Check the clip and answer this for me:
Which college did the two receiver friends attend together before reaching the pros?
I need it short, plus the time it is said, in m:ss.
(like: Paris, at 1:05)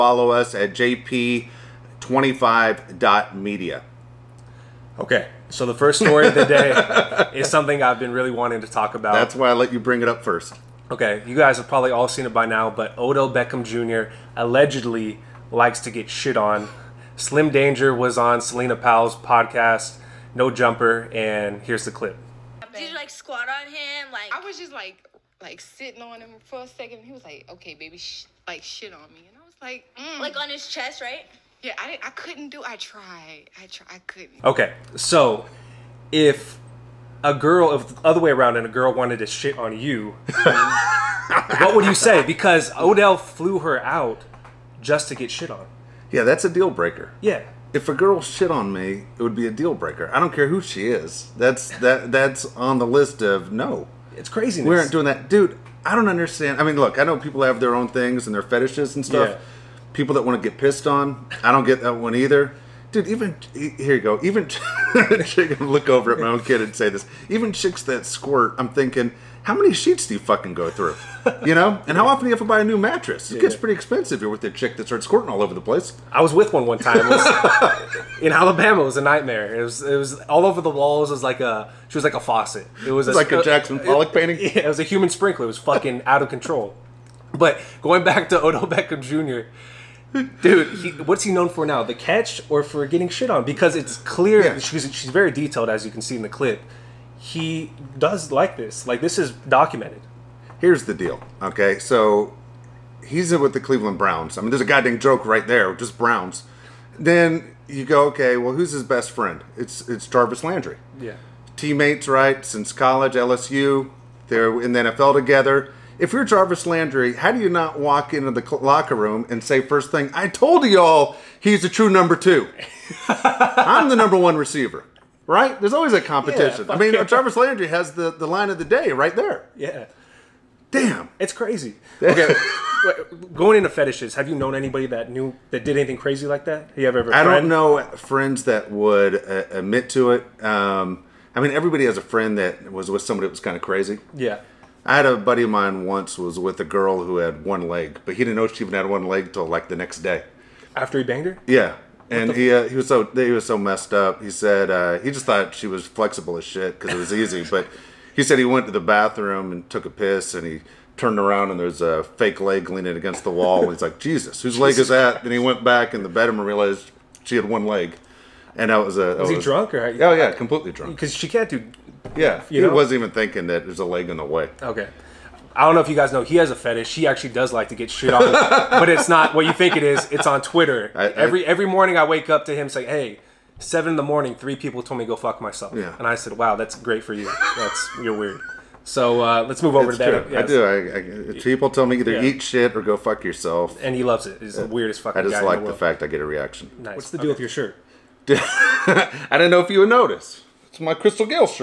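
LSU, at 1:53.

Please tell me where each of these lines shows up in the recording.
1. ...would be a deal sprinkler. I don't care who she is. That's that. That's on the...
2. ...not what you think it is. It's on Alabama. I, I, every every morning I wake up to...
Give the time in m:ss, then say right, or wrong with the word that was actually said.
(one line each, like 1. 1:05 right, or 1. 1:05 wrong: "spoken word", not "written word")
1. 0:49 wrong: "breaker", not "sprinkler"
2. 2:59 wrong: "Twitter", not "Alabama".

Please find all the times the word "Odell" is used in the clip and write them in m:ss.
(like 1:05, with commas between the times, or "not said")
0:12, 0:42, 1:28.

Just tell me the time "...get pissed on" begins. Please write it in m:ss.
1:00.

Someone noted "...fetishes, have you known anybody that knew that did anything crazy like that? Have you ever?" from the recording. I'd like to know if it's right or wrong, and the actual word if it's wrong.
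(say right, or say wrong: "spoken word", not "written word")
right.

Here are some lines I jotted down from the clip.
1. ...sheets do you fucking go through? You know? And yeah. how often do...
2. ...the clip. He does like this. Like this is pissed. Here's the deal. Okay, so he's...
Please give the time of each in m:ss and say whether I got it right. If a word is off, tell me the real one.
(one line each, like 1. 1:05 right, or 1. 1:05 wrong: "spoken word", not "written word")
1. 1:09 right
2. 1:36 wrong: "documented", not "pissed".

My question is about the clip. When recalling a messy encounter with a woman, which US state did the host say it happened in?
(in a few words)
Alabama.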